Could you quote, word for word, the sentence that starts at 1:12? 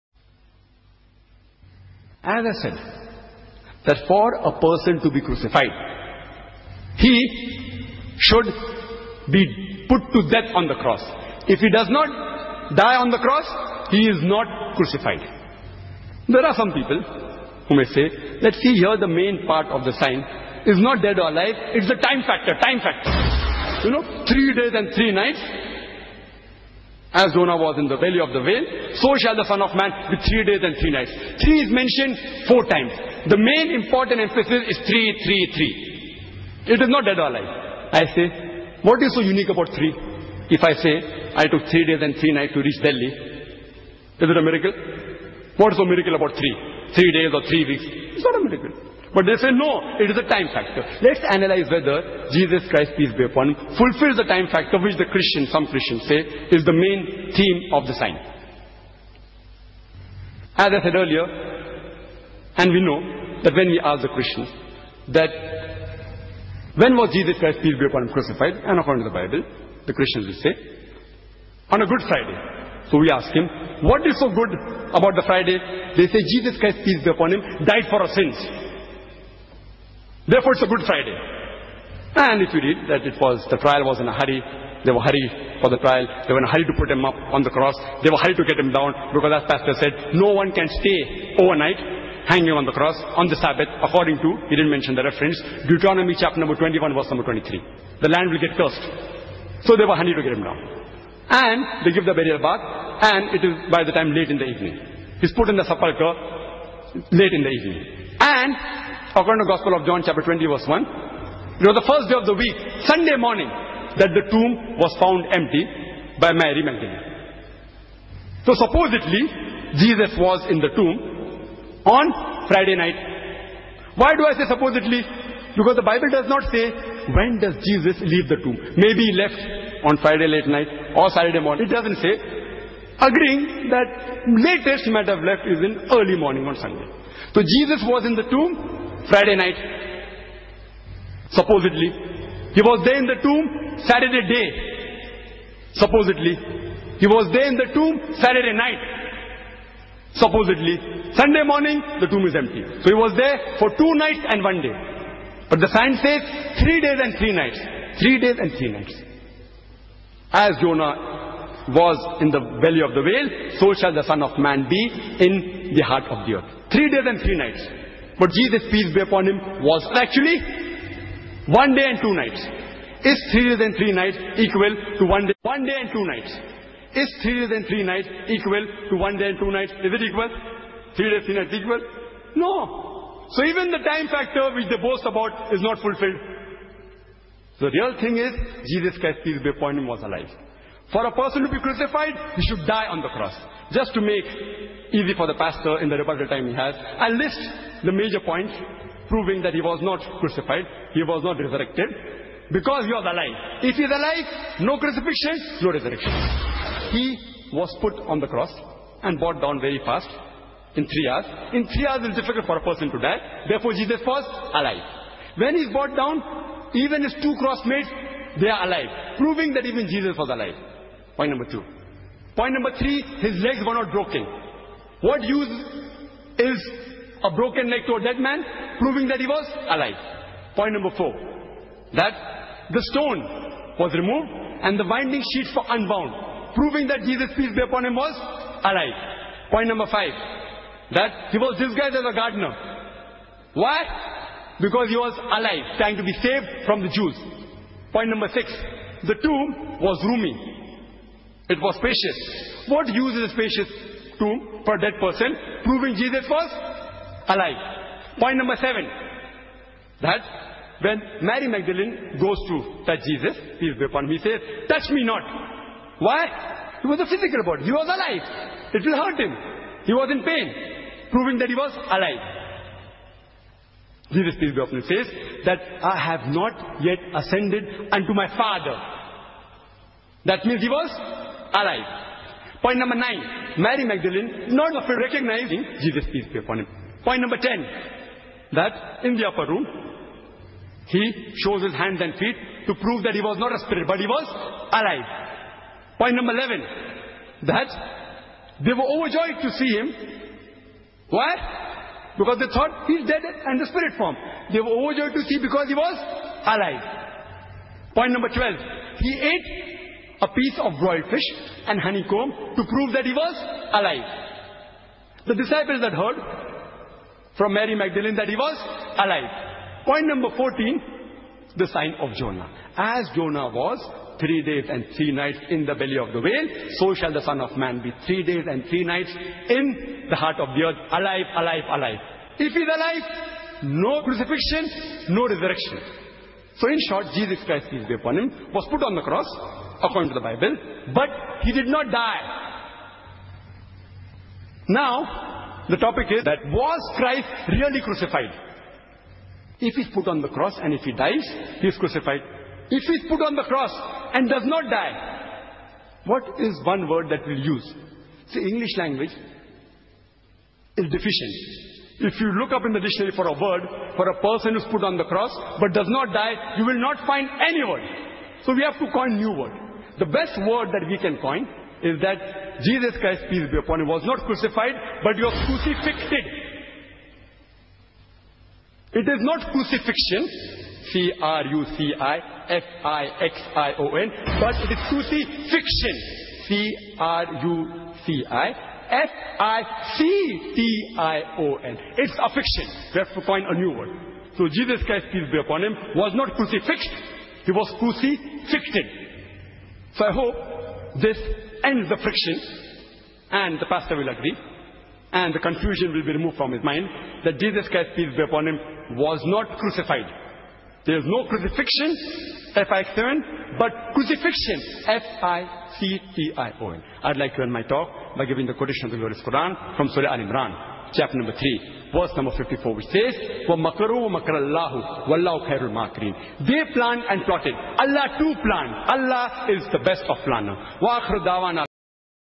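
So we ask him, what is so good about the Friday?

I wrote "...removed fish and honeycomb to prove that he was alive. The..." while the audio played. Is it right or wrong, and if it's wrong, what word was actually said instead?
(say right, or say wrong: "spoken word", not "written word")
wrong: "broiled", not "removed".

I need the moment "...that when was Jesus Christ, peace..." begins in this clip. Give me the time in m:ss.
1:05.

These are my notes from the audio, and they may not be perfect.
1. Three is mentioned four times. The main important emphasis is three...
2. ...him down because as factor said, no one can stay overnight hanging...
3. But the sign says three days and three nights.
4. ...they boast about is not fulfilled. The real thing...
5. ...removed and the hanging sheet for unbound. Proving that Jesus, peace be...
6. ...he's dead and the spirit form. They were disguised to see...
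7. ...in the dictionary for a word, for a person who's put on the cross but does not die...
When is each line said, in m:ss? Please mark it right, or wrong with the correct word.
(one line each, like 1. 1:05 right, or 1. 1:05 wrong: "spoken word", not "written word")
1. 0:31 right
2. 1:28 wrong: "pastor", not "factor"
3. 2:35 right
4. 3:04 right
5. 3:53 wrong: "winding", not "hanging"
6. 5:02 wrong: "overjoyed", not "disguised"
7. 6:02 right.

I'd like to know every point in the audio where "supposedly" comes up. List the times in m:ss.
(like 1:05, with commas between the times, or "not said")
1:58, 2:04, 2:21, 2:25, 2:30.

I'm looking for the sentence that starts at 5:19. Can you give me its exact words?
Point number 14, the sign of Jonah.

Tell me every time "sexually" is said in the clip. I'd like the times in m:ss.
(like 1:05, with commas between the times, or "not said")
not said.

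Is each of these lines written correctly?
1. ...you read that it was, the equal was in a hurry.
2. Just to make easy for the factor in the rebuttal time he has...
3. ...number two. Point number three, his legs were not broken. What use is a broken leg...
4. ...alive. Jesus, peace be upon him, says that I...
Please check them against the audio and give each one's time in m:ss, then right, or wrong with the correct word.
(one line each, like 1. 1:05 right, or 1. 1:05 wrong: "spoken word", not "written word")
1. 1:22 wrong: "trial", not "equal"
2. 3:13 wrong: "pastor", not "factor"
3. 3:41 right
4. 4:31 right.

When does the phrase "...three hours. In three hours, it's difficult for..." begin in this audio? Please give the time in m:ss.
3:30.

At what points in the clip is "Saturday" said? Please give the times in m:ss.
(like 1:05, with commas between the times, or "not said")
2:11, 2:23, 2:28.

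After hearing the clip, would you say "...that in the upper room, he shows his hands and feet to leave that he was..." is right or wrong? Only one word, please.
wrong.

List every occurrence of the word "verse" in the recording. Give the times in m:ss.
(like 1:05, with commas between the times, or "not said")
1:36, 1:50, 7:01.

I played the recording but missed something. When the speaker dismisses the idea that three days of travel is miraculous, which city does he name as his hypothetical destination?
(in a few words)
Delhi.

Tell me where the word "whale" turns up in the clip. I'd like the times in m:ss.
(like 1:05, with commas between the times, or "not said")
0:28, 2:43, 5:26.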